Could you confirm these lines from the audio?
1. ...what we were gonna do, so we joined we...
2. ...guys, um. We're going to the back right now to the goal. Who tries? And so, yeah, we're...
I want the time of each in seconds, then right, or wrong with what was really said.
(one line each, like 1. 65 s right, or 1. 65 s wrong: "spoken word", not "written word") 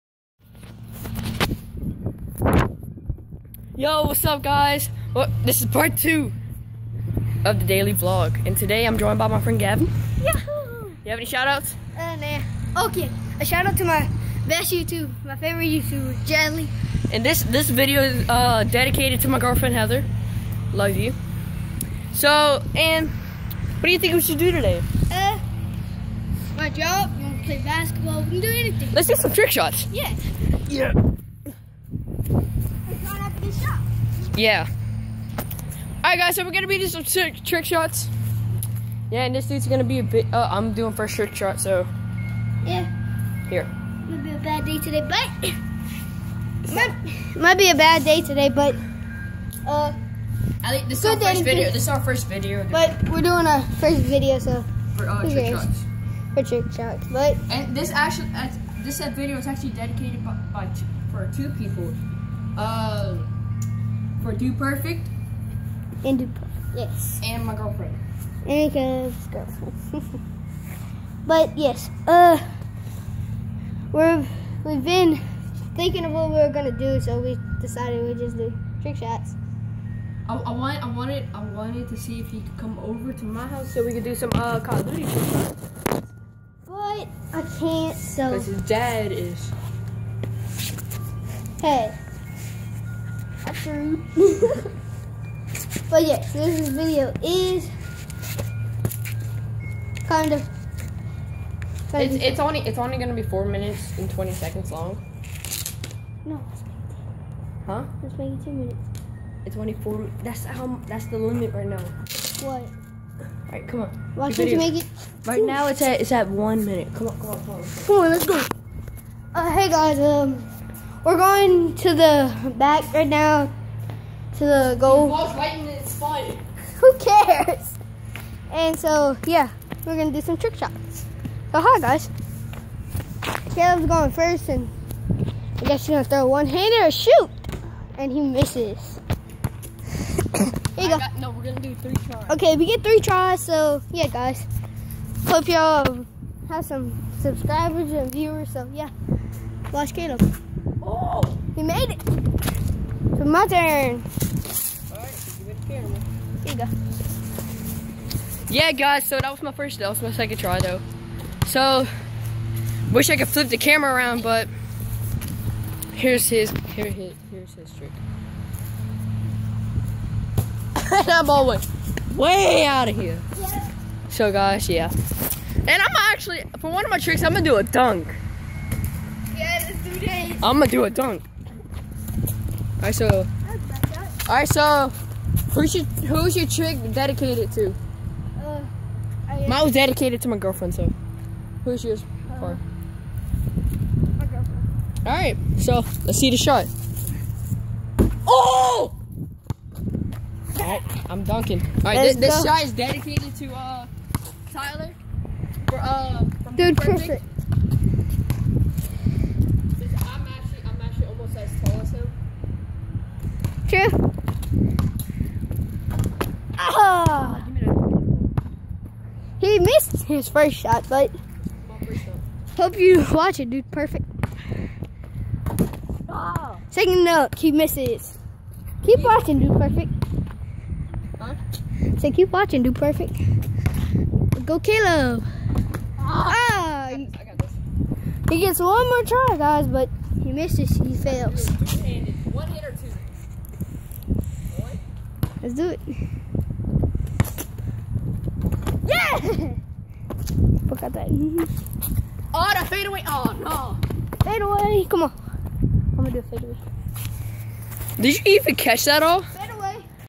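1. 76 s wrong: "decided", not "joined"
2. 119 s wrong: "cares", not "tries".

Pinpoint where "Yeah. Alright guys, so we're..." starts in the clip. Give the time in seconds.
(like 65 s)
34 s.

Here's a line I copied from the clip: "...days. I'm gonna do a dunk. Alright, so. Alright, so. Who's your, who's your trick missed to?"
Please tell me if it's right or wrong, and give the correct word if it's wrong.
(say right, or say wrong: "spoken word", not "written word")
wrong: "dedicated", not "missed".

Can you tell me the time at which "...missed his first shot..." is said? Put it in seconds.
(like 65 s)
219 s.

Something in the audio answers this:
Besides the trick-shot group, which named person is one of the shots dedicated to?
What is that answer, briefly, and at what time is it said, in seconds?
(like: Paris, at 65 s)
Tyler, at 204 s.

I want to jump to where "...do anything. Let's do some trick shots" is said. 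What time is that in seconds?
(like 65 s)
28 s.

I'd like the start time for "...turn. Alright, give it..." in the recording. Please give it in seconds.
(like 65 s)
153 s.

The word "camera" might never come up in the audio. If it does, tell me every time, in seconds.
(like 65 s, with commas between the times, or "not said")
155 s, 163 s.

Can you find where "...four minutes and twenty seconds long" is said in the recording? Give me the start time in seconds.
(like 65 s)
103 s.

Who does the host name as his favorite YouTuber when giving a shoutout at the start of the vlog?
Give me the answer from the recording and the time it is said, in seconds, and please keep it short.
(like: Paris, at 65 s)
Jadley, at 16 s.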